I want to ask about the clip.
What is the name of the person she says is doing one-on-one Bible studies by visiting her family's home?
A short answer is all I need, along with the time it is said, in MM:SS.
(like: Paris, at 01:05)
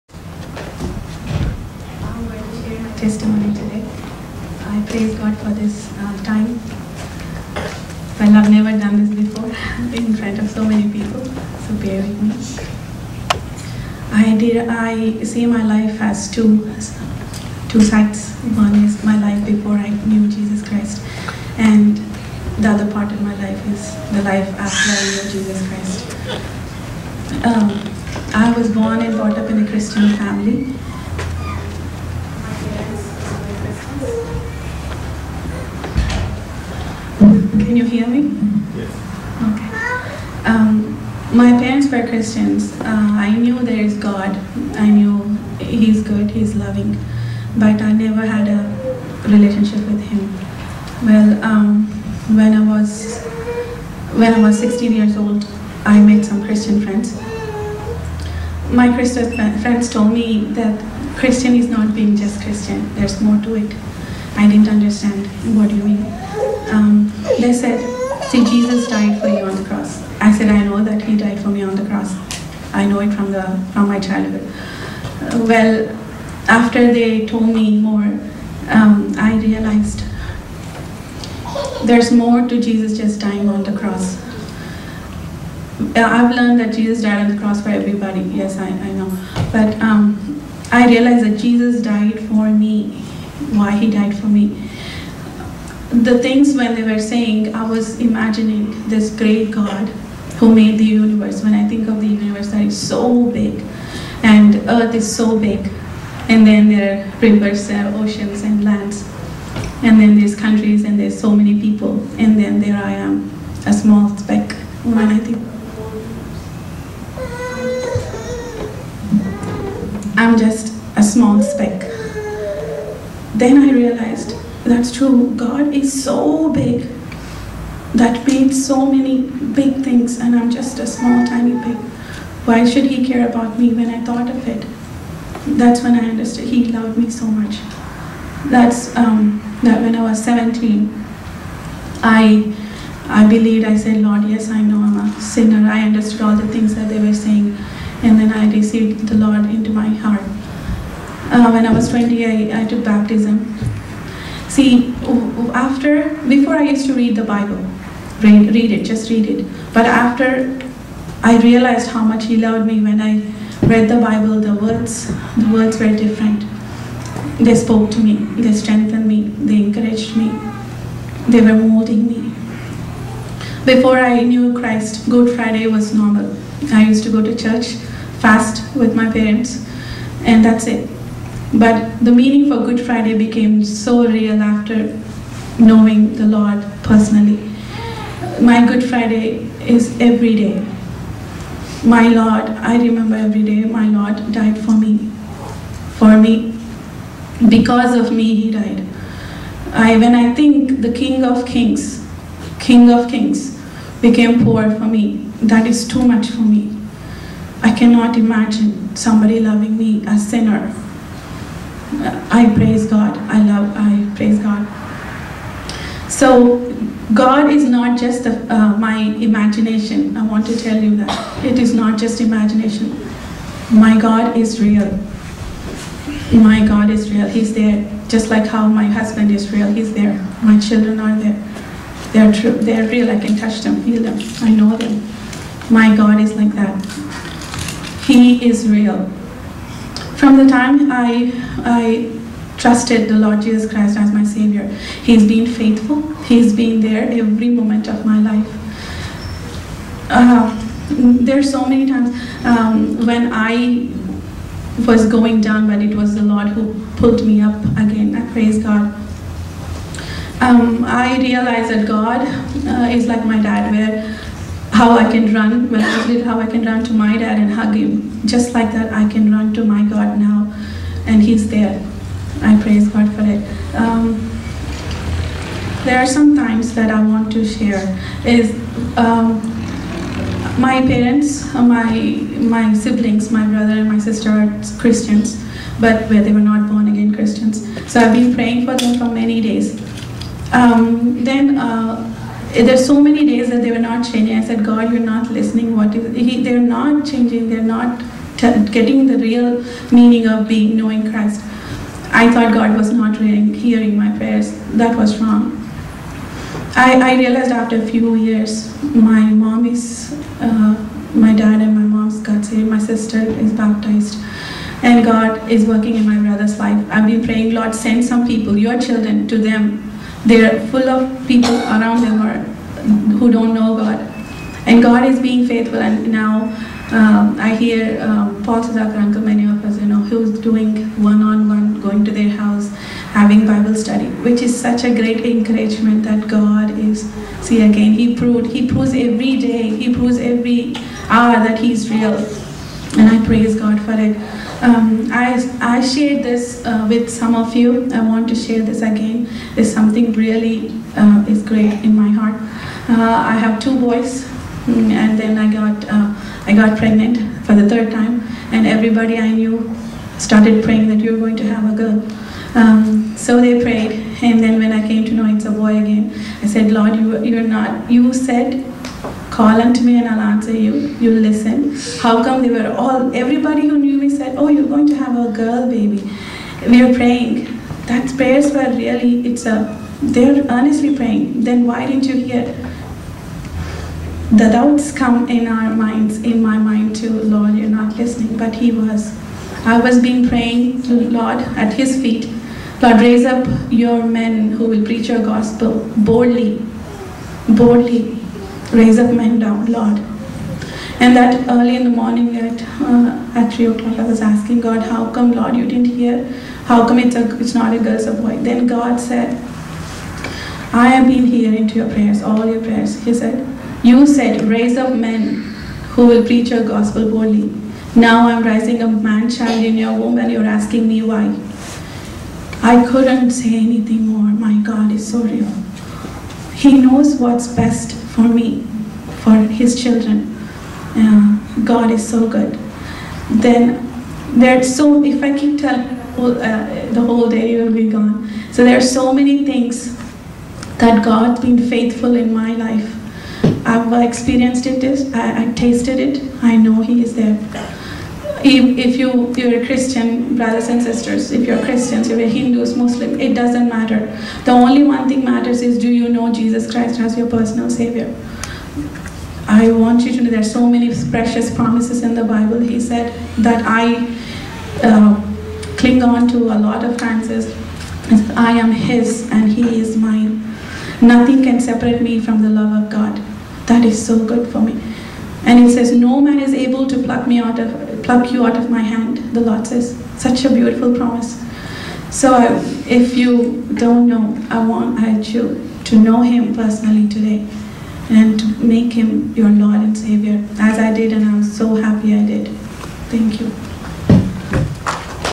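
Paul Sudhakaranka, at 05:28.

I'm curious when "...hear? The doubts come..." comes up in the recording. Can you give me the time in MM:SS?
06:22.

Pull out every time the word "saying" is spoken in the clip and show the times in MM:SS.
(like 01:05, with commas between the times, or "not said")
01:37, 02:27.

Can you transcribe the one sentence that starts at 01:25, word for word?
Uh, I've learned that Jesus died on the cross for everybody.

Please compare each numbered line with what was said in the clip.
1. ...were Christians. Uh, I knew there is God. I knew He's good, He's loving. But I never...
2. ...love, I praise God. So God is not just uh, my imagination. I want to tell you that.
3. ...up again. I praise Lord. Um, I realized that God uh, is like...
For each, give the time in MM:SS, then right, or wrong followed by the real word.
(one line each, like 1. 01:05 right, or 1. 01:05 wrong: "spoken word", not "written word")
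1. 00:41 right
2. 03:33 right
3. 04:17 wrong: "God", not "Lord".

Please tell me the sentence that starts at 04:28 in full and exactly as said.
Just like that, I can run to my God now, and He's there.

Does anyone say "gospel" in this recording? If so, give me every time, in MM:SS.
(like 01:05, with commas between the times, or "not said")
06:35, 06:56.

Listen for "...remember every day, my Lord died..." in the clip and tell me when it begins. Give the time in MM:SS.
03:12.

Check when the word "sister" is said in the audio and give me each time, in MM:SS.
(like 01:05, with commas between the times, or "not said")
04:43, 05:12, 07:30.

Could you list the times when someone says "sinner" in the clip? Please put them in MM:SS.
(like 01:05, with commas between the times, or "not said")
02:25, 03:30.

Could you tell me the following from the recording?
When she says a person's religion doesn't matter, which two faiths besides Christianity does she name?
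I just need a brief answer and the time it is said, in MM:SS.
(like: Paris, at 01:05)
Hindus, Muslim, at 07:32.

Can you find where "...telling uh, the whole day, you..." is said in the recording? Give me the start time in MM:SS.
07:15.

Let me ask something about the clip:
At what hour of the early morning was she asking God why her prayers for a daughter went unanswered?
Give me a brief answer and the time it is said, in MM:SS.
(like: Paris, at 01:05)
3 o'clock, at 06:43.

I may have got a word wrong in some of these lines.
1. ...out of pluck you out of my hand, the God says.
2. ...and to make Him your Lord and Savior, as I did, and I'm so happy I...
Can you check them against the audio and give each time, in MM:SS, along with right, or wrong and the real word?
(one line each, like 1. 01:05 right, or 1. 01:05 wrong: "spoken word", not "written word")
1. 07:57 wrong: "Lord", not "God"
2. 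08:08 right.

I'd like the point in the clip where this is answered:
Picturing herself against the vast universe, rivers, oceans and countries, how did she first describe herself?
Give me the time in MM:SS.
01:53.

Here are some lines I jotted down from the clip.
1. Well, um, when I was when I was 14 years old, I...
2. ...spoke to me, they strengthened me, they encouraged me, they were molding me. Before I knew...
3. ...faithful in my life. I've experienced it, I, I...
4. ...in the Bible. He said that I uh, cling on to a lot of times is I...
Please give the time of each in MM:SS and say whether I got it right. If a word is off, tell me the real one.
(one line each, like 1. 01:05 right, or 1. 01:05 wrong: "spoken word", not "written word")
1. 00:51 wrong: "16", not "14"
2. 02:47 right
3. 07:21 right
4. 07:42 right.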